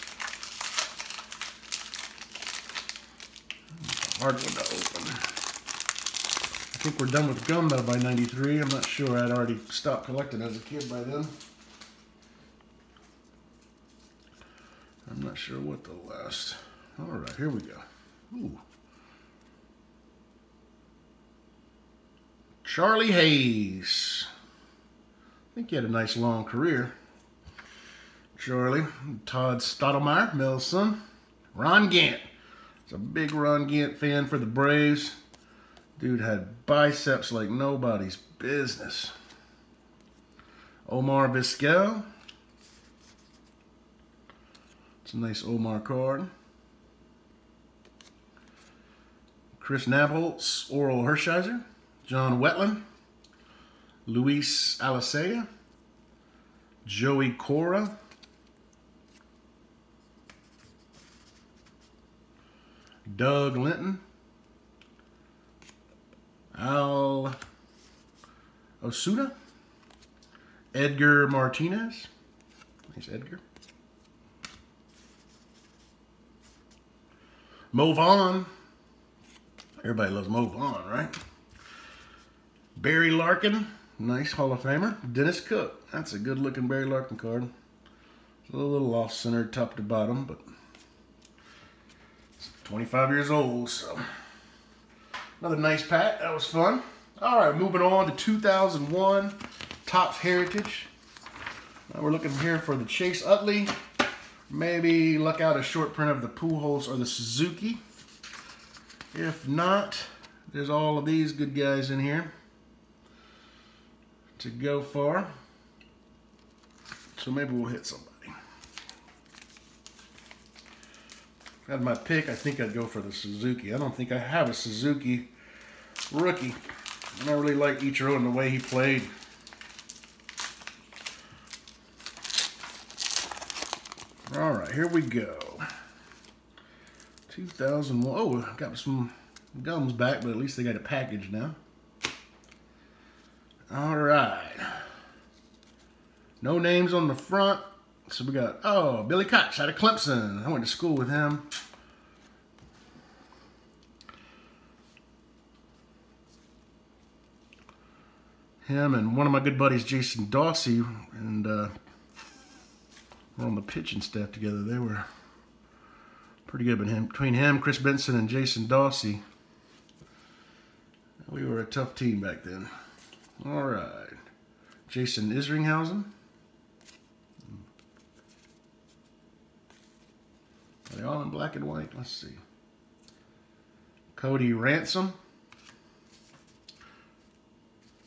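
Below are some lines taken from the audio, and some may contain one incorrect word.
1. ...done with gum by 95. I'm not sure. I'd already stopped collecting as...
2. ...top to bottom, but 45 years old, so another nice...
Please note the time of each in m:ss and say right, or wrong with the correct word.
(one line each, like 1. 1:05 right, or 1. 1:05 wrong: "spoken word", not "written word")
1. 0:07 wrong: "93", not "95"
2. 1:29 wrong: "25", not "45".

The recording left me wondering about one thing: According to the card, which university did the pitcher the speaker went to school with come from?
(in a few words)
Clemson.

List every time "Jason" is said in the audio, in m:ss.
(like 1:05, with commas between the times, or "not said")
2:39, 2:48, 2:54.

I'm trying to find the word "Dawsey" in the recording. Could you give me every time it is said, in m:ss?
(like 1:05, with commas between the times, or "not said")
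2:40, 2:48.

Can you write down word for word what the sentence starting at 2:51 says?
We were a tough team back then.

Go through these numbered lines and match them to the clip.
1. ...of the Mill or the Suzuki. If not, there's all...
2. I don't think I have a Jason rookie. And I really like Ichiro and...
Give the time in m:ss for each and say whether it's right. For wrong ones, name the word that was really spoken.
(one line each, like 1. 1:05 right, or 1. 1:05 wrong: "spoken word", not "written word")
1. 1:46 wrong: "Pujols", not "Mill"
2. 2:03 wrong: "Suzuki", not "Jason".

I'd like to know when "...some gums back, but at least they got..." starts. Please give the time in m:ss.
2:18.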